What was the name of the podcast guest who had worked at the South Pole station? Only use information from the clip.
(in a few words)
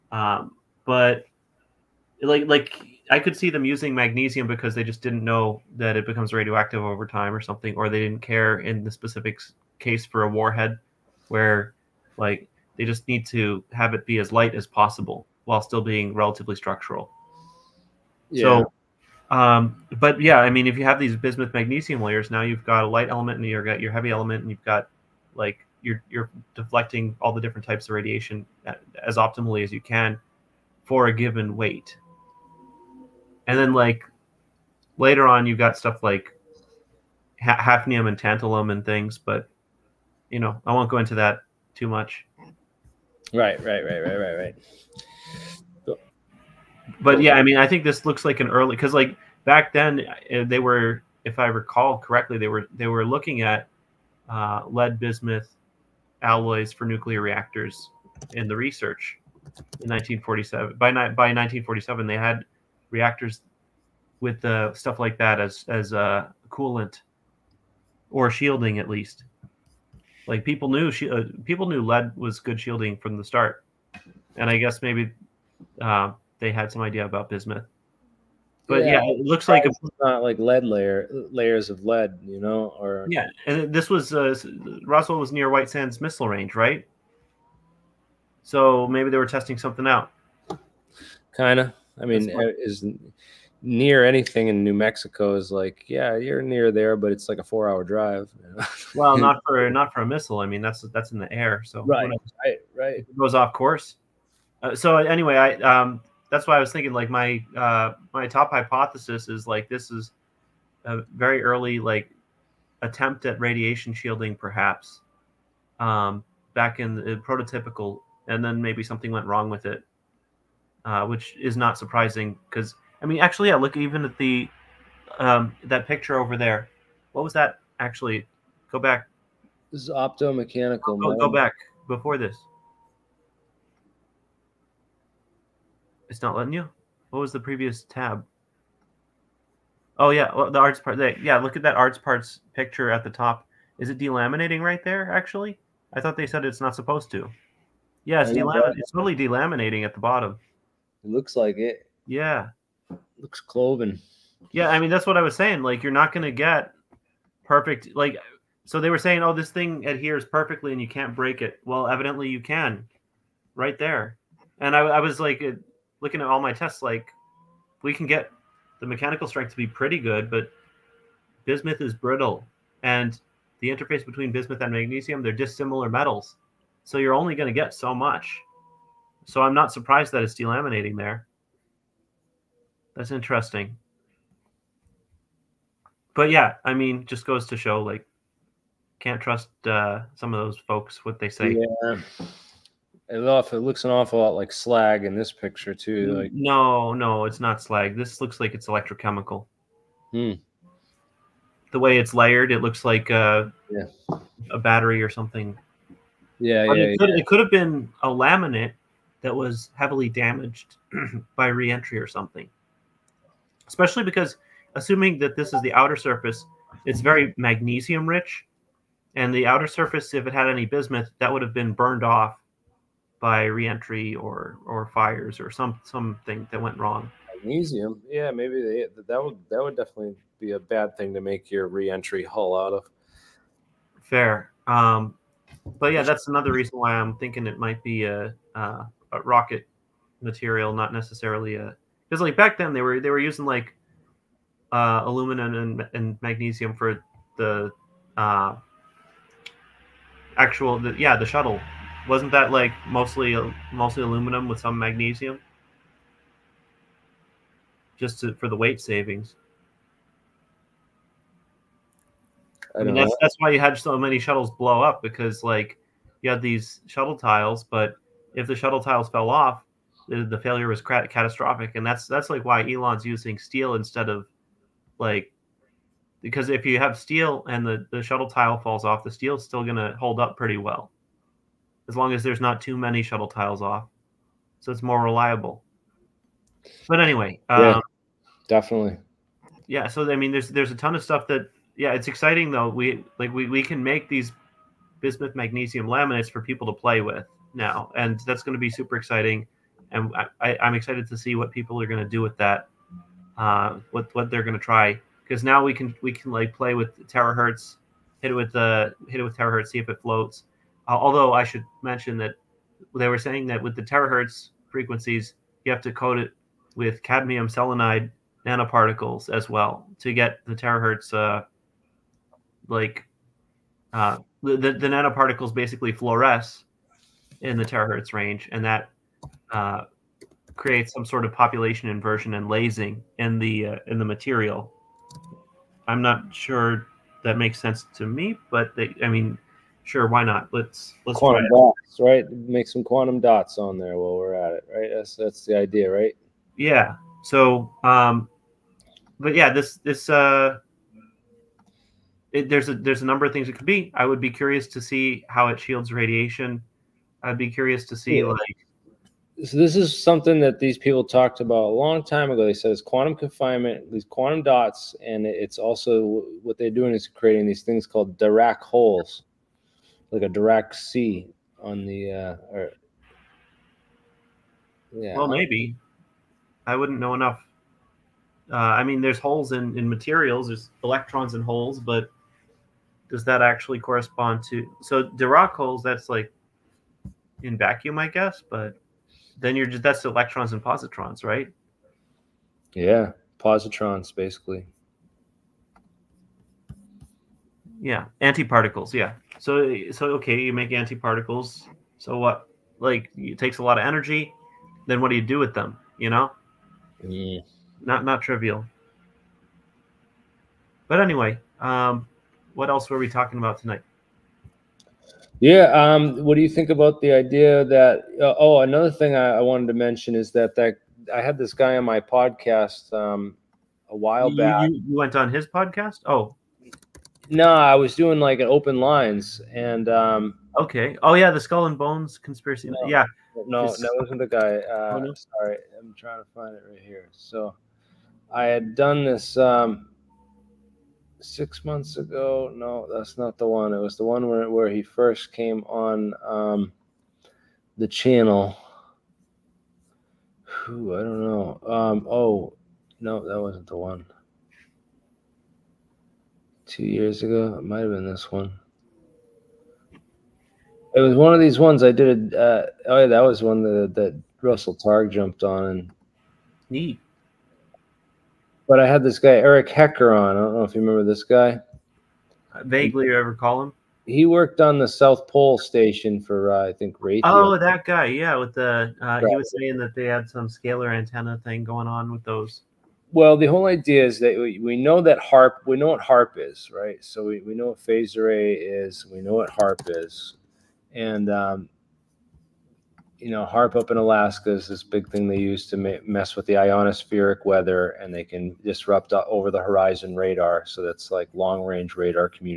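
Eric Hecker.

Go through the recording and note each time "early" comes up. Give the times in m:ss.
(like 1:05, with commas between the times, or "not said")
0:48, 1:51.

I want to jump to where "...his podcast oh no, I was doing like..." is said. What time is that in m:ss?
7:05.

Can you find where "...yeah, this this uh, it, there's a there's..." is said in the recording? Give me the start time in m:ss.
5:49.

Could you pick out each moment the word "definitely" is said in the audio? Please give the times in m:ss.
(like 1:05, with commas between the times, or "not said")
3:49, 4:48.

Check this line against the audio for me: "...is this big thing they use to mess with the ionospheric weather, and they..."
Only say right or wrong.
right.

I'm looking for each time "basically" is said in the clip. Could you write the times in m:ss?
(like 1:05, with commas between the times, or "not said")
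5:25, 6:34.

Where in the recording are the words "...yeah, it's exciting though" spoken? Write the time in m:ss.
4:51.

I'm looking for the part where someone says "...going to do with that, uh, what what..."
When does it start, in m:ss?
5:01.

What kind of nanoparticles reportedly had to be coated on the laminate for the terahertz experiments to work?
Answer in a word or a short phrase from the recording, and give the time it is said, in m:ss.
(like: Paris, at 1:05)
cadmium selenide, at 5:17.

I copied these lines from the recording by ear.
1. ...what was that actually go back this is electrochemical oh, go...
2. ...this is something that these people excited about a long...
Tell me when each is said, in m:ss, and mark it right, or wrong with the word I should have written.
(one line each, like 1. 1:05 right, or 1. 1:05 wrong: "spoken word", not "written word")
1. 2:07 wrong: "optomechanical", not "electrochemical"
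2. 5:59 wrong: "talked", not "excited".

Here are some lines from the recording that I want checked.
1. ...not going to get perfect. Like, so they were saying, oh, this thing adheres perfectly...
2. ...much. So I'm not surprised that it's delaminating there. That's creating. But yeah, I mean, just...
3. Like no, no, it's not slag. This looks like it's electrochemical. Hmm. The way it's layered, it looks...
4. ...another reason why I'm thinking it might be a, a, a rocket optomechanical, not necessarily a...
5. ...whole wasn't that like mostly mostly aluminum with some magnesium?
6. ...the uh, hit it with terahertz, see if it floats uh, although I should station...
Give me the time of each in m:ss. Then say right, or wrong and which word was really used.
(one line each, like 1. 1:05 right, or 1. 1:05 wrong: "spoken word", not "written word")
1. 2:35 right
2. 2:57 wrong: "interesting", not "creating"
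3. 3:16 right
4. 3:56 wrong: "material", not "optomechanical"
5. 4:11 wrong: "shuttle", not "whole"
6. 5:08 wrong: "mention", not "station".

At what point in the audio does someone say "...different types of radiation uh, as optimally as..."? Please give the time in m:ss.
0:27.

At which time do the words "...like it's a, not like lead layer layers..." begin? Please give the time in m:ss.
1:19.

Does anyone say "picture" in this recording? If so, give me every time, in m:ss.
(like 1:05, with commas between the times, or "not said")
2:05, 2:22, 3:15.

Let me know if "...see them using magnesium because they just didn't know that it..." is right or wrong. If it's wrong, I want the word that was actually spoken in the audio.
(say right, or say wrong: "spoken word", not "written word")
right.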